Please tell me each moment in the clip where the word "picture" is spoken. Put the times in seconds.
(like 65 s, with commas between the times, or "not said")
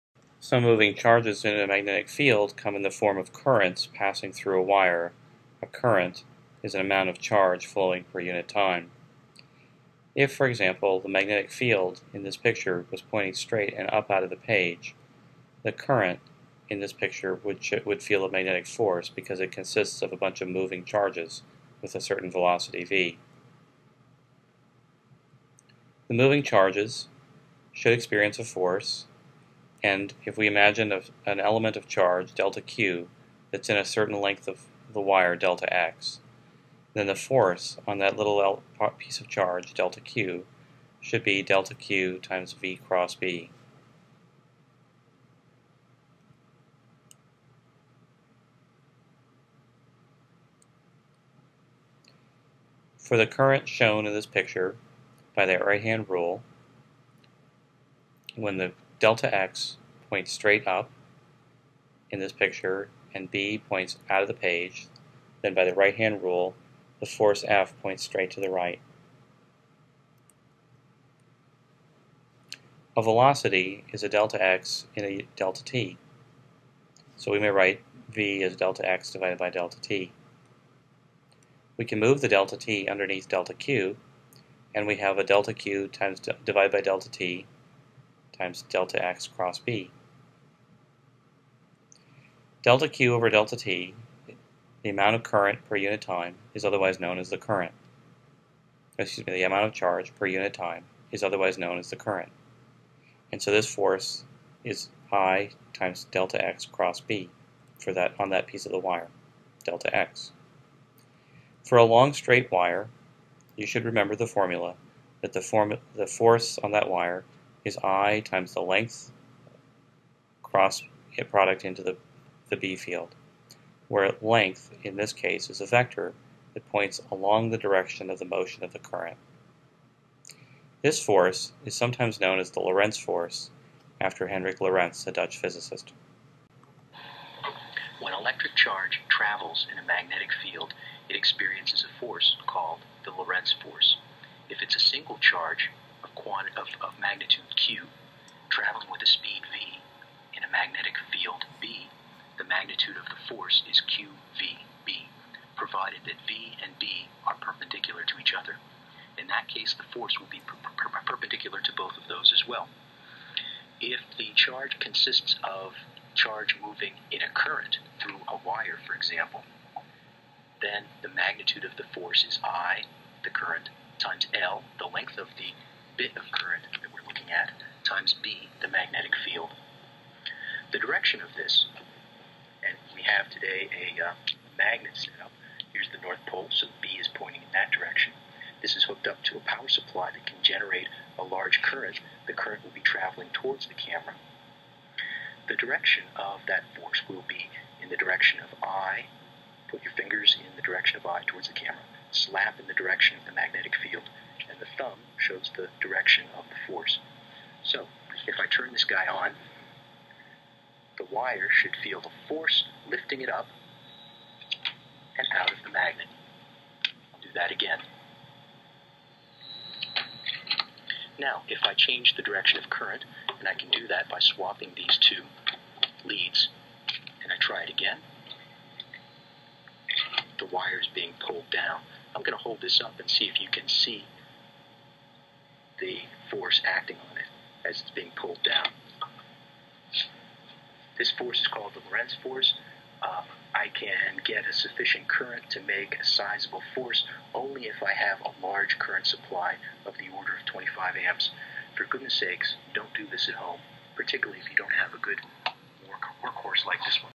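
12 s, 16 s, 54 s, 62 s.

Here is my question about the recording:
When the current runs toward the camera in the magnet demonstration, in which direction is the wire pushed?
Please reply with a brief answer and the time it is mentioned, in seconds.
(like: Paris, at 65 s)
up and out of the magnet, at 213 s.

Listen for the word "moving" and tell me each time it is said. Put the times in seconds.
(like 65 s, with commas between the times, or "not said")
0 s, 20 s, 26 s, 166 s.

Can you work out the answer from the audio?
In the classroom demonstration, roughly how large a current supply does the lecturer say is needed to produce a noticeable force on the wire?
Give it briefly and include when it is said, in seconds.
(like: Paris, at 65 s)
25 amps, at 250 s.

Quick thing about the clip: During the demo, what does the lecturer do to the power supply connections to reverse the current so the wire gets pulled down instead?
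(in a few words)
swapping these two leads.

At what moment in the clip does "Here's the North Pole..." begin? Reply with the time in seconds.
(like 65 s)
185 s.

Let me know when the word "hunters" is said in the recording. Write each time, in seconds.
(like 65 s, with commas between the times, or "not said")
not said.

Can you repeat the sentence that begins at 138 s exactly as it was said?
When electric charge travels in a magnetic field, it experiences a force called the Lorentz force.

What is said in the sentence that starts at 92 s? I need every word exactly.
Delta Q over delta T, the amount of current per unit time, is otherwise known as the current.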